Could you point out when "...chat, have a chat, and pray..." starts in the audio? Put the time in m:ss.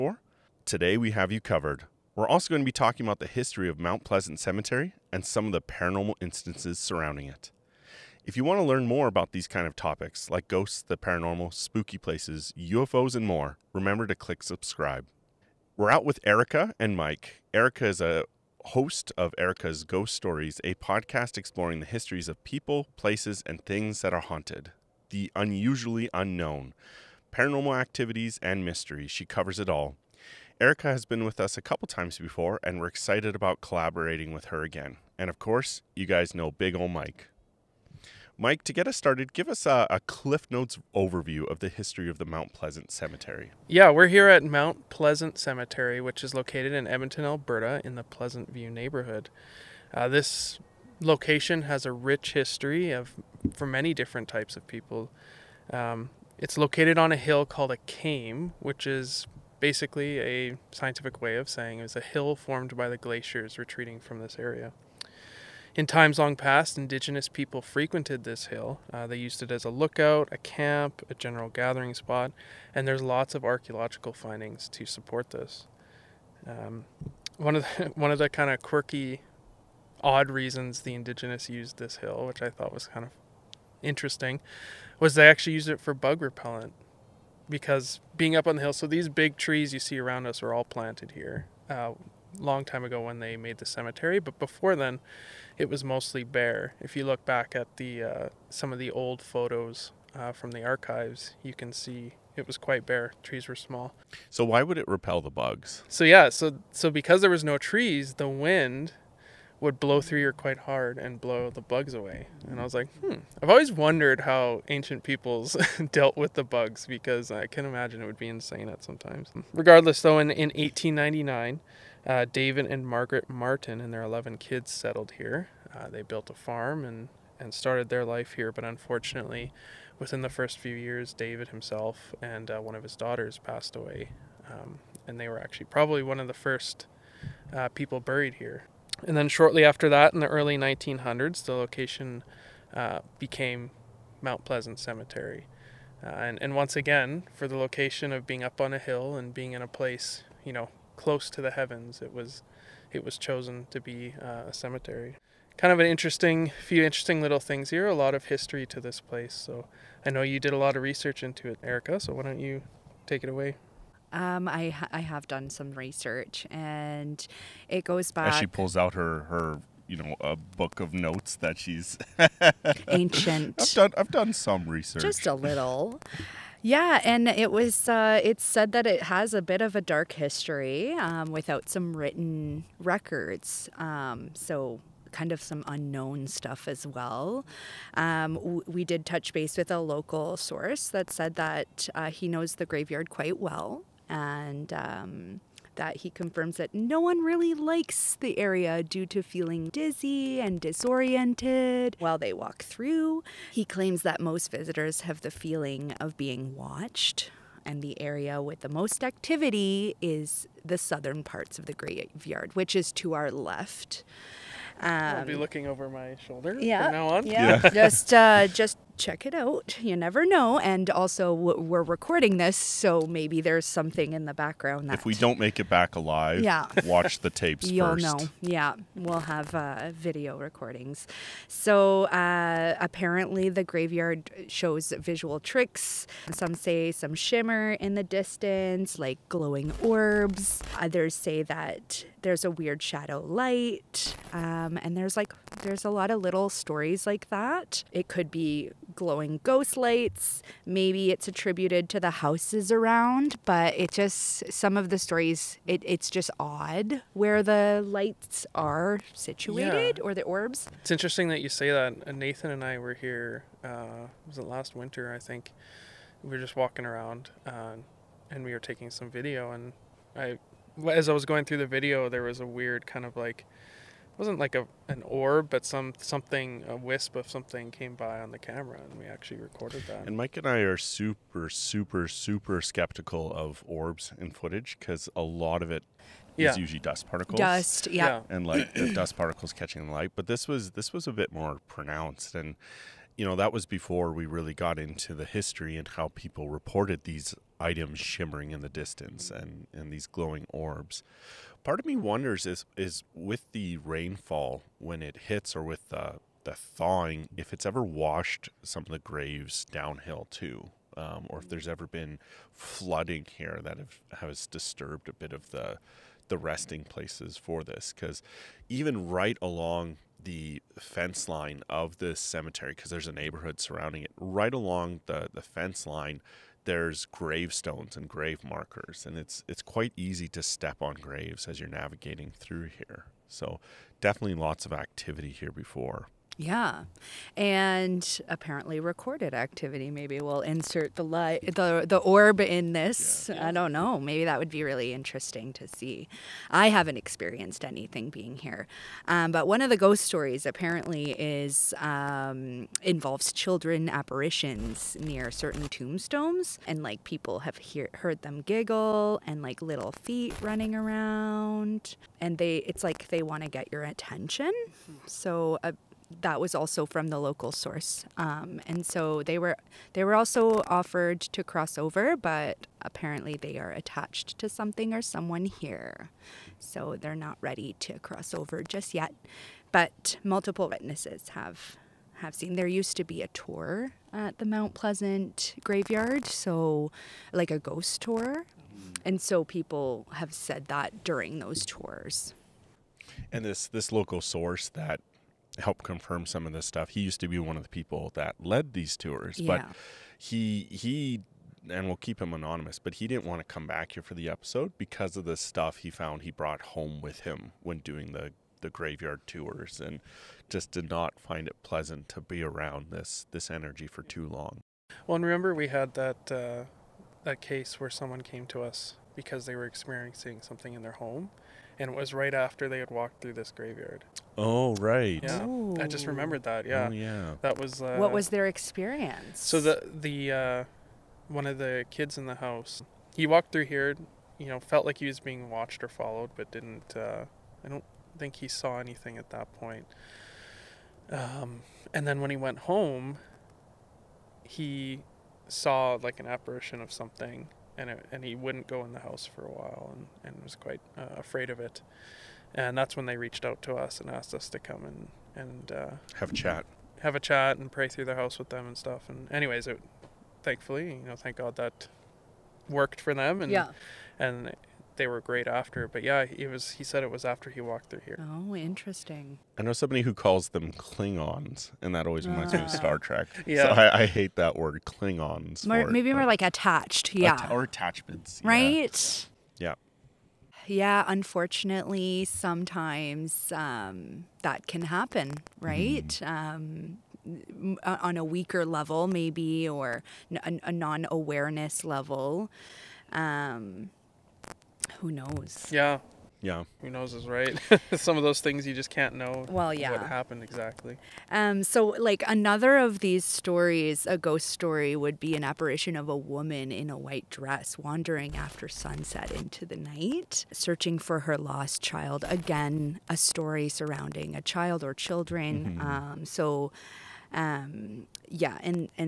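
7:36.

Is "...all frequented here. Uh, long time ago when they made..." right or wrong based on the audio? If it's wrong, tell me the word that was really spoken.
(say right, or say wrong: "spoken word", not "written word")
wrong: "planted", not "frequented".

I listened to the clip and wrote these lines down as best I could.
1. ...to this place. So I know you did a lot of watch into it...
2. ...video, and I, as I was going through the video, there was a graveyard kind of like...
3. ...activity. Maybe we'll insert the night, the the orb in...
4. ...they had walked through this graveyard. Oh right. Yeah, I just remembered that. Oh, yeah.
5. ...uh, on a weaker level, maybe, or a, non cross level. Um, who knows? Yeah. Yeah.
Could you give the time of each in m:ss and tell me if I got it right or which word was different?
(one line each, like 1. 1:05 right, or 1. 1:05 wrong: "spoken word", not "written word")
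1. 2:38 wrong: "research", not "watch"
2. 4:29 wrong: "weird", not "graveyard"
3. 5:39 wrong: "light", not "night"
4. 7:02 right
5. 8:07 wrong: "awareness", not "cross".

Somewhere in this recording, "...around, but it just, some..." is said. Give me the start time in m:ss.
4:12.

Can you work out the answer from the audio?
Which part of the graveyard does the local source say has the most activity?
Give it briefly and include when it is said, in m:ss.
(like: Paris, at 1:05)
southern parts, at 3:30.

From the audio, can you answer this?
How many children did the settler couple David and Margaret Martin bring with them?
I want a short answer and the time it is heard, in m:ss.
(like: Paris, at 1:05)
11, at 2:04.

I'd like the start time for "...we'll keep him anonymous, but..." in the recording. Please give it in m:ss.
6:41.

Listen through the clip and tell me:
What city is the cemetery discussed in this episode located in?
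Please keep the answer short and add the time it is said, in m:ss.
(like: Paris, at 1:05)
Edmonton, at 0:46.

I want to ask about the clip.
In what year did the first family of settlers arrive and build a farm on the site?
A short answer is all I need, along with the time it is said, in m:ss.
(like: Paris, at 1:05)
1899, at 2:00.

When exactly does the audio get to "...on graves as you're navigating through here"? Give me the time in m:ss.
5:30.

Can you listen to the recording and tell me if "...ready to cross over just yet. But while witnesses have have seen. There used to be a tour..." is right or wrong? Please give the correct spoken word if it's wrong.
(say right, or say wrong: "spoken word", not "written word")
wrong: "multiple", not "while".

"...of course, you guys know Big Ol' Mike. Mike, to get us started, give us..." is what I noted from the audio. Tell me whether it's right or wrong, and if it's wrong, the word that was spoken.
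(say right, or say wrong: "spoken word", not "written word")
right.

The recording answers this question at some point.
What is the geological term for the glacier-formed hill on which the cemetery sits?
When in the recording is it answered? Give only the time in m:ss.
0:57.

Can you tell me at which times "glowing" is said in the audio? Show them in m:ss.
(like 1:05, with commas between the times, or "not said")
3:59, 4:08, 5:00.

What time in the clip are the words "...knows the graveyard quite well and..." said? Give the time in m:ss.
3:12.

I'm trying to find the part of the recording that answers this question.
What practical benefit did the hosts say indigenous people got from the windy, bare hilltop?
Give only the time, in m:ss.
1:25.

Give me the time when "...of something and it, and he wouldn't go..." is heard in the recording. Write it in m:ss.
7:26.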